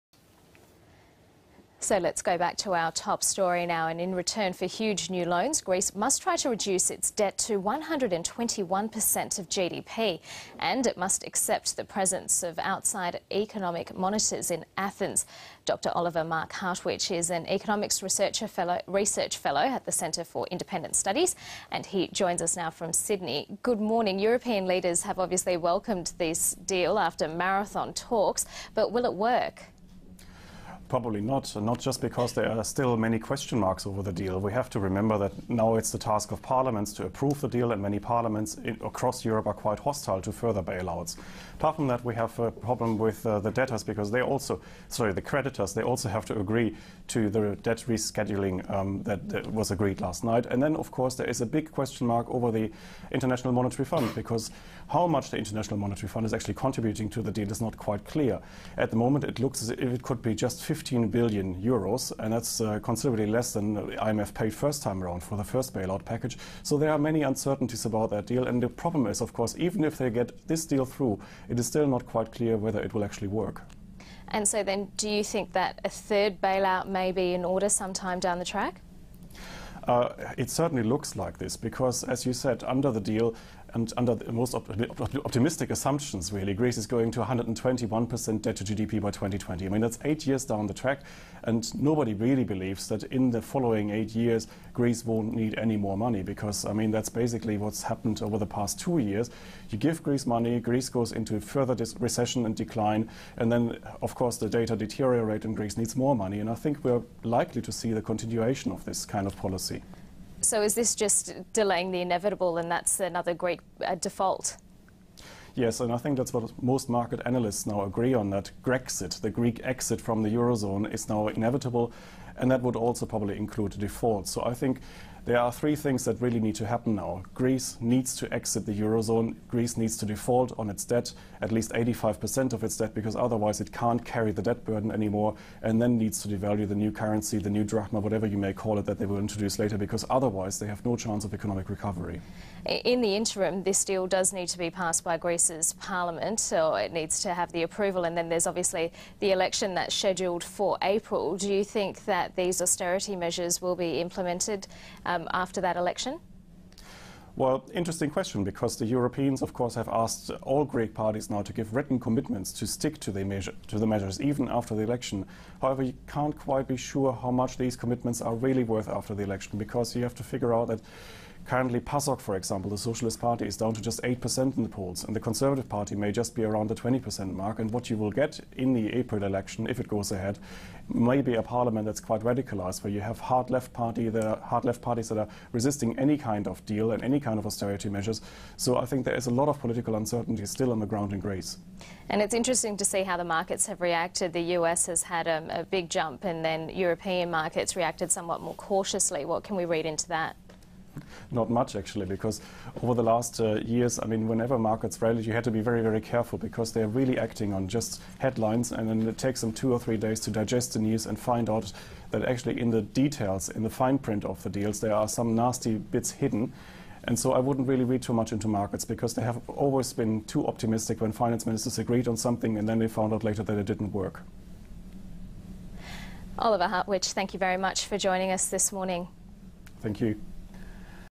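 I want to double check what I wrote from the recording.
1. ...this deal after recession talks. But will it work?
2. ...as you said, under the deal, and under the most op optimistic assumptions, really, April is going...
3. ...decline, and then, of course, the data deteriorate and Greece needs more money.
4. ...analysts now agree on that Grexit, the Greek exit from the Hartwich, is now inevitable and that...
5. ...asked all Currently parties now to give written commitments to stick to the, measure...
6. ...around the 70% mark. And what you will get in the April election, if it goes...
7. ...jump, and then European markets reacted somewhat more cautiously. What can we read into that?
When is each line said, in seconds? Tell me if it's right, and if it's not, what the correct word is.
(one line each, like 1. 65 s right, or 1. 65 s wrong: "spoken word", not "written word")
1. 26 s wrong: "marathon", not "recession"
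2. 82 s wrong: "Greece", not "April"
3. 102 s right
4. 117 s wrong: "Eurozone", not "Hartwich"
5. 159 s wrong: "Greek", not "Currently"
6. 176 s wrong: "20", not "70"
7. 195 s right.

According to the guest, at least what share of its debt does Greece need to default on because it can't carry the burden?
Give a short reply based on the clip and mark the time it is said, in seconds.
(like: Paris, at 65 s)
85%, at 131 s.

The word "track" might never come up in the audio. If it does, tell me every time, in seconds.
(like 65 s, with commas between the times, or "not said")
78 s, 90 s.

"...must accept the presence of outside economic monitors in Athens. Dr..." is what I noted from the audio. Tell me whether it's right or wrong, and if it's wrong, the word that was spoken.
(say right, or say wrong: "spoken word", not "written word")
right.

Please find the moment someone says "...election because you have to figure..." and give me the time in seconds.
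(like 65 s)
169 s.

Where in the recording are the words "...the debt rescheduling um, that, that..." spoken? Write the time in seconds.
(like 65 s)
47 s.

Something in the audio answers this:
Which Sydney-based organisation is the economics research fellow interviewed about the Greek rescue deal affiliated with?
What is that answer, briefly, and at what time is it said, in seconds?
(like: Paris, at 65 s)
Centre for Independent Studies, at 19 s.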